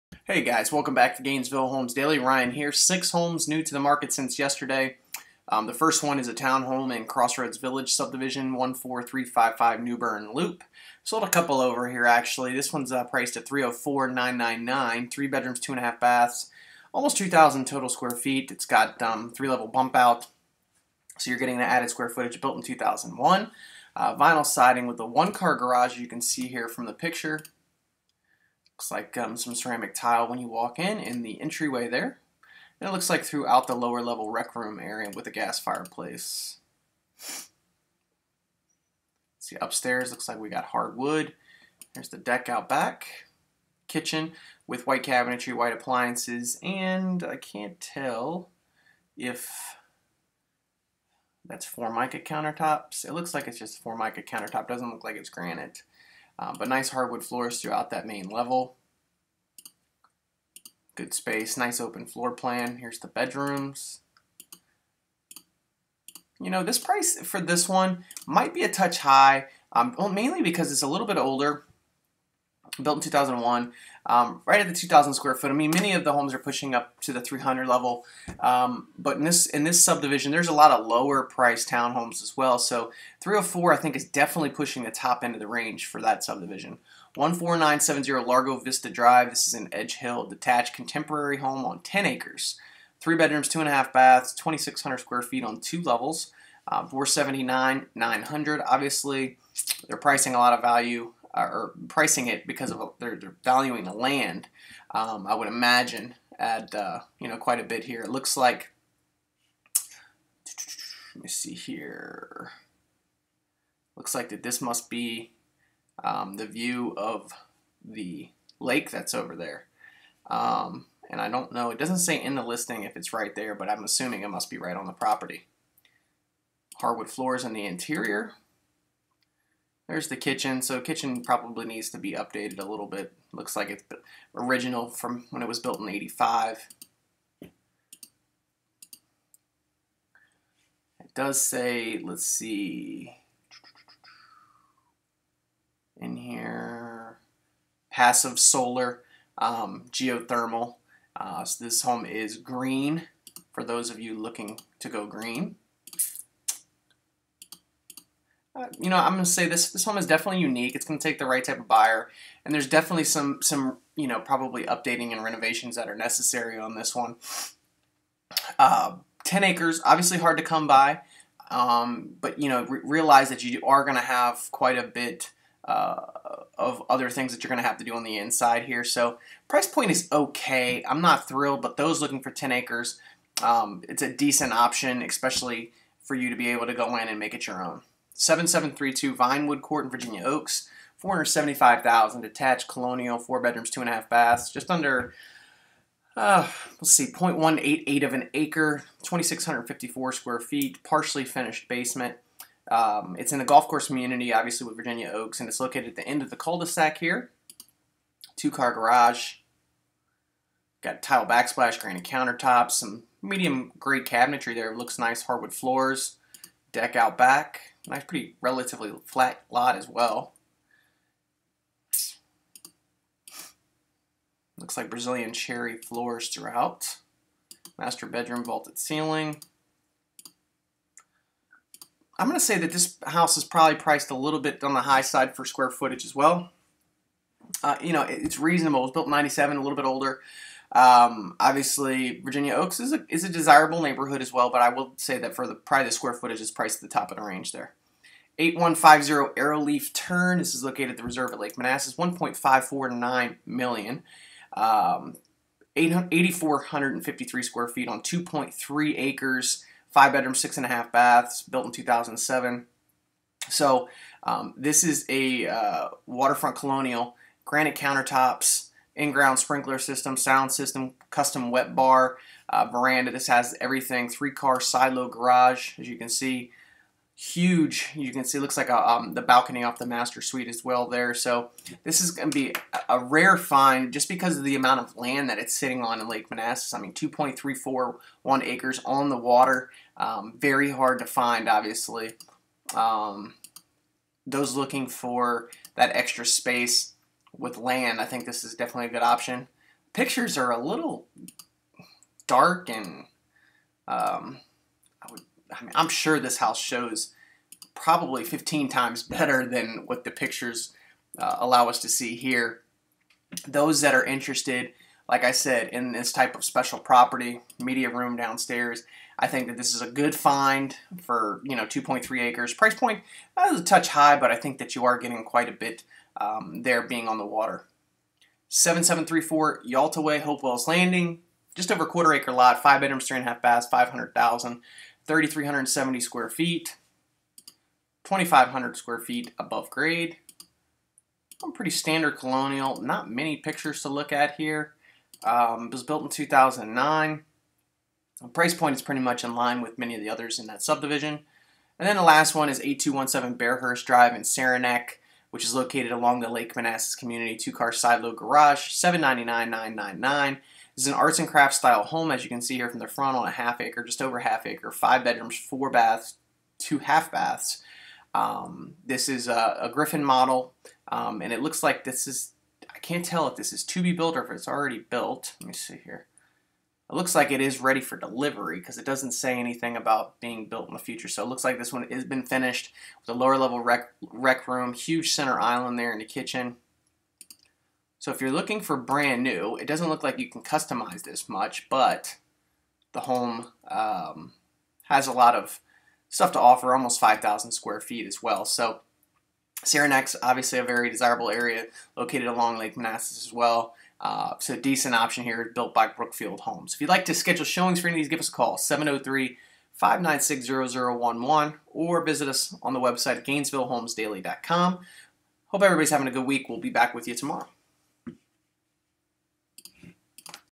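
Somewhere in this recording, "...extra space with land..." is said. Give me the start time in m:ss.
4:55.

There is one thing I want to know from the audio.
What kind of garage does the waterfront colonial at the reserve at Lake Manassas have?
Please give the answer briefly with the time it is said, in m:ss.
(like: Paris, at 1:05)
Three-car silo garage, at 4:34.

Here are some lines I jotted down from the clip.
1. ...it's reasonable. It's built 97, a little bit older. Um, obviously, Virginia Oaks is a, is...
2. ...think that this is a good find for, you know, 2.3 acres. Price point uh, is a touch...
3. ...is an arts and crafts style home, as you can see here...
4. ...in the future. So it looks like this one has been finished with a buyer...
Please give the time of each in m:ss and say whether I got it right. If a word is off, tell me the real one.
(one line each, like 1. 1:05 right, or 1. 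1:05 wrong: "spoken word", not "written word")
1. 3:58 right
2. 5:19 right
3. 6:00 right
4. 6:20 wrong: "lower", not "buyer".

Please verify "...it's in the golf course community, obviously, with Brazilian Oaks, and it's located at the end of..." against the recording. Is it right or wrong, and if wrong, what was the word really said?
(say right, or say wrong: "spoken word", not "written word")
wrong: "Virginia", not "Brazilian".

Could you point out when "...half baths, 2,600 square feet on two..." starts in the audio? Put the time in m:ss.
1:33.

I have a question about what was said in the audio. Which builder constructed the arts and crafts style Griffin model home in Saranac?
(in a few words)
Brookfield Homes.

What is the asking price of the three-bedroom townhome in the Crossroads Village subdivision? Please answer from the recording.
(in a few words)
$304,999.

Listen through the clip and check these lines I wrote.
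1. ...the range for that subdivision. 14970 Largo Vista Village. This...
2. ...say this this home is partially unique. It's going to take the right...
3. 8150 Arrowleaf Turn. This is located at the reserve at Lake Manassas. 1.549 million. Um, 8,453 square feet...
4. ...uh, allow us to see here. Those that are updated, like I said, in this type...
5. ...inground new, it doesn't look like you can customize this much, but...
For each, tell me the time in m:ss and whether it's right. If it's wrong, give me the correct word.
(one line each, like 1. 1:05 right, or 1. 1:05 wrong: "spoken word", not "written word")
1. 1:25 wrong: "Drive", not "Village"
2. 2:39 wrong: "definitely", not "partially"
3. 4:08 right
4. 5:11 wrong: "interested", not "updated"
5. 6:28 wrong: "brand", not "inground".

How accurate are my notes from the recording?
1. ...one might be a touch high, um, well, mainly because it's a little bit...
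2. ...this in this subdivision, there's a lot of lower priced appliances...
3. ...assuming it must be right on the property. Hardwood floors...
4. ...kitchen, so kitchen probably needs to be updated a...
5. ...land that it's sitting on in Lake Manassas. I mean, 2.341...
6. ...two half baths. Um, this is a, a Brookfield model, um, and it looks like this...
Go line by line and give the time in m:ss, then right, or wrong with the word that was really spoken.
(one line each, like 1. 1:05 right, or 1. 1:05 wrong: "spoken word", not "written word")
1. 1:07 right
2. 1:19 wrong: "townhomes", not "appliances"
3. 2:03 right
4. 2:10 right
5. 4:44 right
6. 6:06 wrong: "Griffin", not "Brookfield".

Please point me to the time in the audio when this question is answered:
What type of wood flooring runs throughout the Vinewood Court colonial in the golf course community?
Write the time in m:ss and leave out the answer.
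3:44.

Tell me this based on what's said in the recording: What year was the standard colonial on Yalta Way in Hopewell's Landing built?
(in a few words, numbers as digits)
2009.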